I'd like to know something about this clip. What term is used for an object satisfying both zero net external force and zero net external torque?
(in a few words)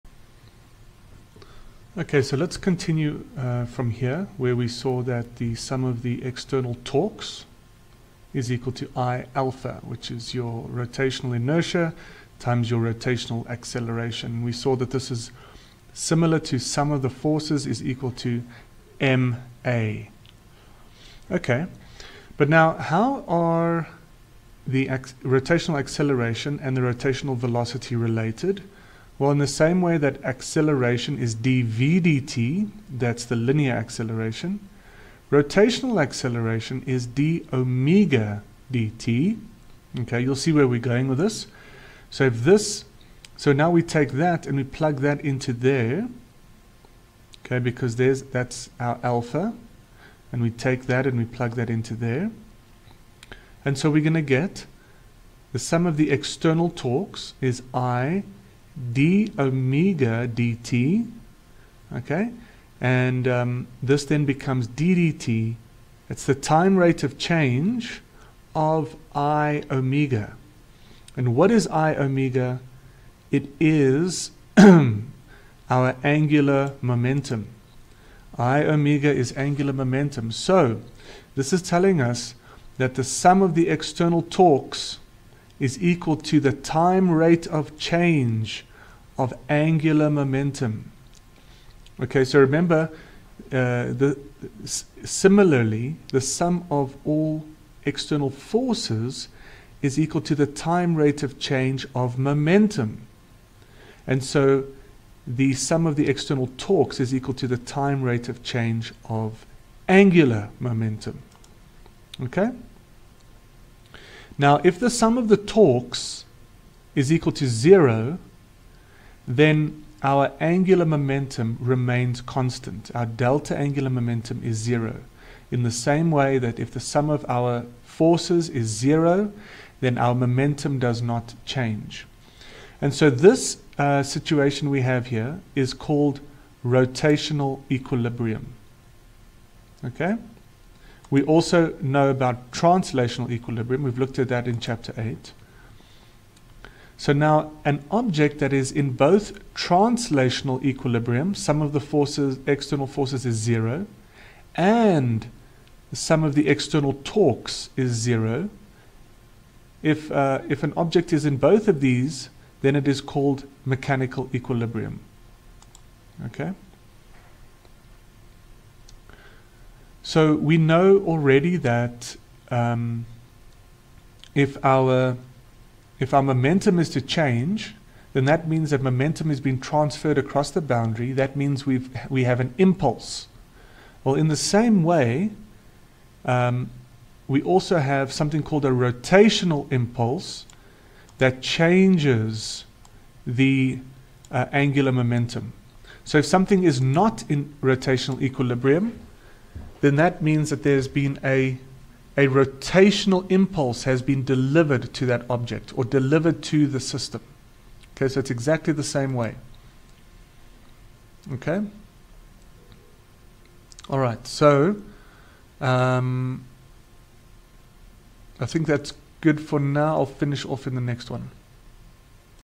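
mechanical equilibrium.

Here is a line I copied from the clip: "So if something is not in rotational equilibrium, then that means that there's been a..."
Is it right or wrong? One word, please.
right.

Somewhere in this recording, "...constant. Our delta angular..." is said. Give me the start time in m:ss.
2:02.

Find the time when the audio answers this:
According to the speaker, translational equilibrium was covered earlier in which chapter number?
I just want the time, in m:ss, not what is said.
2:24.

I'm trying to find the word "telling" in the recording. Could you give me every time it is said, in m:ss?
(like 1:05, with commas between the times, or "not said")
1:21.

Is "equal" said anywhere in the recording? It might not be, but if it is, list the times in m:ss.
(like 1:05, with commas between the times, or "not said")
0:08, 0:17, 1:25, 1:39, 1:47, 1:57.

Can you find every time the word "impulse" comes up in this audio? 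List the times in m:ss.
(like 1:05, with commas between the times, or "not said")
3:02, 3:09, 3:23.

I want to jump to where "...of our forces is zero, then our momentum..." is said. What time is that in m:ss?
2:07.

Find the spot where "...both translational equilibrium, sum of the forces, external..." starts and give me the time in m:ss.
2:28.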